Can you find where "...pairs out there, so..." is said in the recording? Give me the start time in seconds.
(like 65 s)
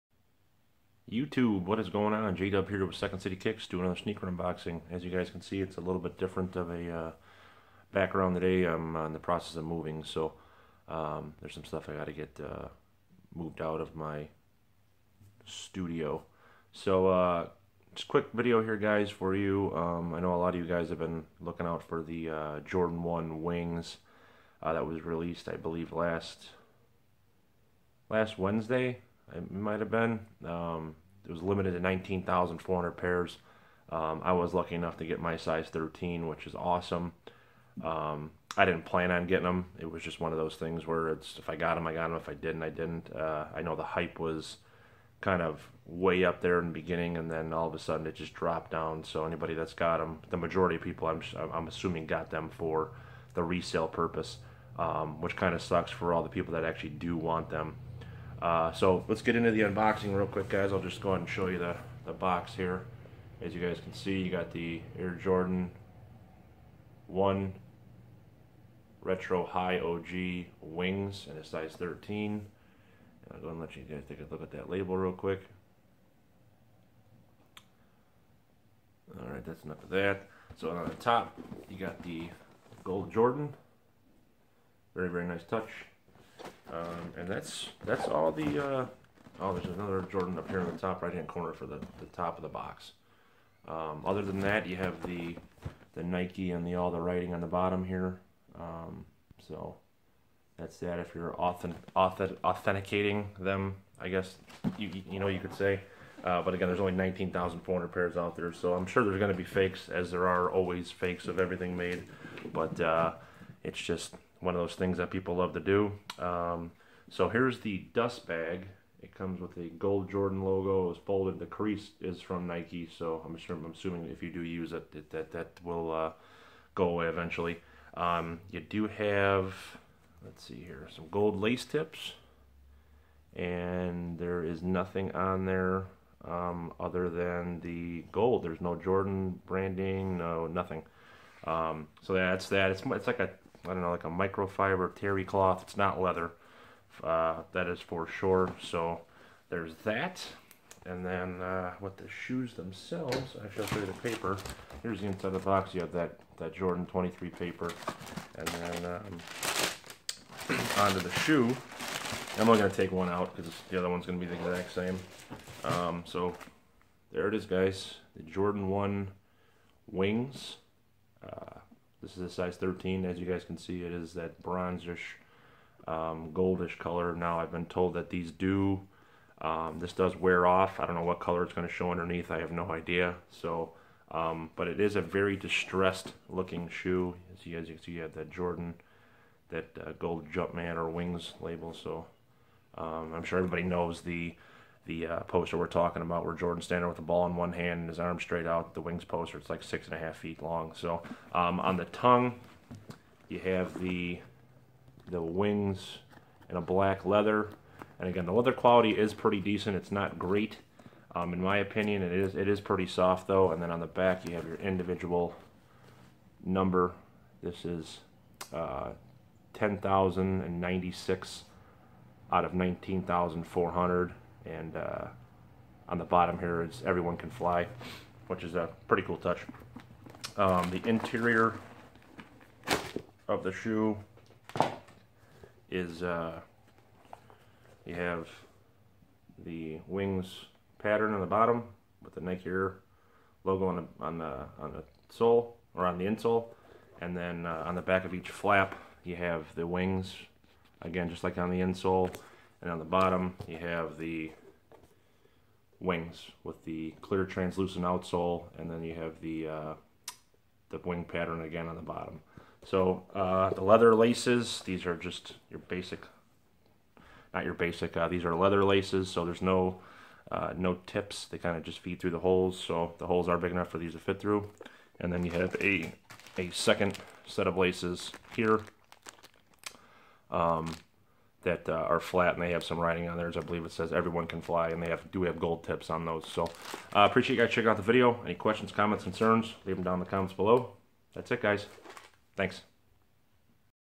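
107 s.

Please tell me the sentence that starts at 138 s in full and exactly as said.
There's no Jordan branding, no nothing.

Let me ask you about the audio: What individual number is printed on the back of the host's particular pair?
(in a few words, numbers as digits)
10,096.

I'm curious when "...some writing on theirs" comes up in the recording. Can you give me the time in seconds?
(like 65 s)
282 s.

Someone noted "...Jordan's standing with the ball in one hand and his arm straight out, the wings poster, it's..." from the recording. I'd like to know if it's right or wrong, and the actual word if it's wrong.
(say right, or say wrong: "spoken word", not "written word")
right.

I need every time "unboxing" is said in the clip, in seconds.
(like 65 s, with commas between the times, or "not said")
4 s, 59 s.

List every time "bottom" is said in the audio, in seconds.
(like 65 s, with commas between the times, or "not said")
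97 s, 226 s, 241 s, 252 s, 261 s.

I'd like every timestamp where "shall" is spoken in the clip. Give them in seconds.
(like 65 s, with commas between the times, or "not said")
153 s.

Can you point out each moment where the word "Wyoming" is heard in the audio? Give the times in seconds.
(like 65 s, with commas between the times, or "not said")
not said.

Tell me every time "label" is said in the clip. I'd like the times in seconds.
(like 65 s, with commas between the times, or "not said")
74 s, 191 s.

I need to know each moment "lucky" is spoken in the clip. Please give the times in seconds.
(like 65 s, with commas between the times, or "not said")
34 s.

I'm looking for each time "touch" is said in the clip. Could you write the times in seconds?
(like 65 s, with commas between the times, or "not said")
85 s, 229 s.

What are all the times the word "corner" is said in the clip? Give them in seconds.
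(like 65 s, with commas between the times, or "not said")
91 s.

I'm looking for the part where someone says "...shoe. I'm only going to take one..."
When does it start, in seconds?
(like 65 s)
161 s.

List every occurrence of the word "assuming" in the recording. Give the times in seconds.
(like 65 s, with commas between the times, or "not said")
51 s, 123 s.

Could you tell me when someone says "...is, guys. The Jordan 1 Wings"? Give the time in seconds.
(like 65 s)
167 s.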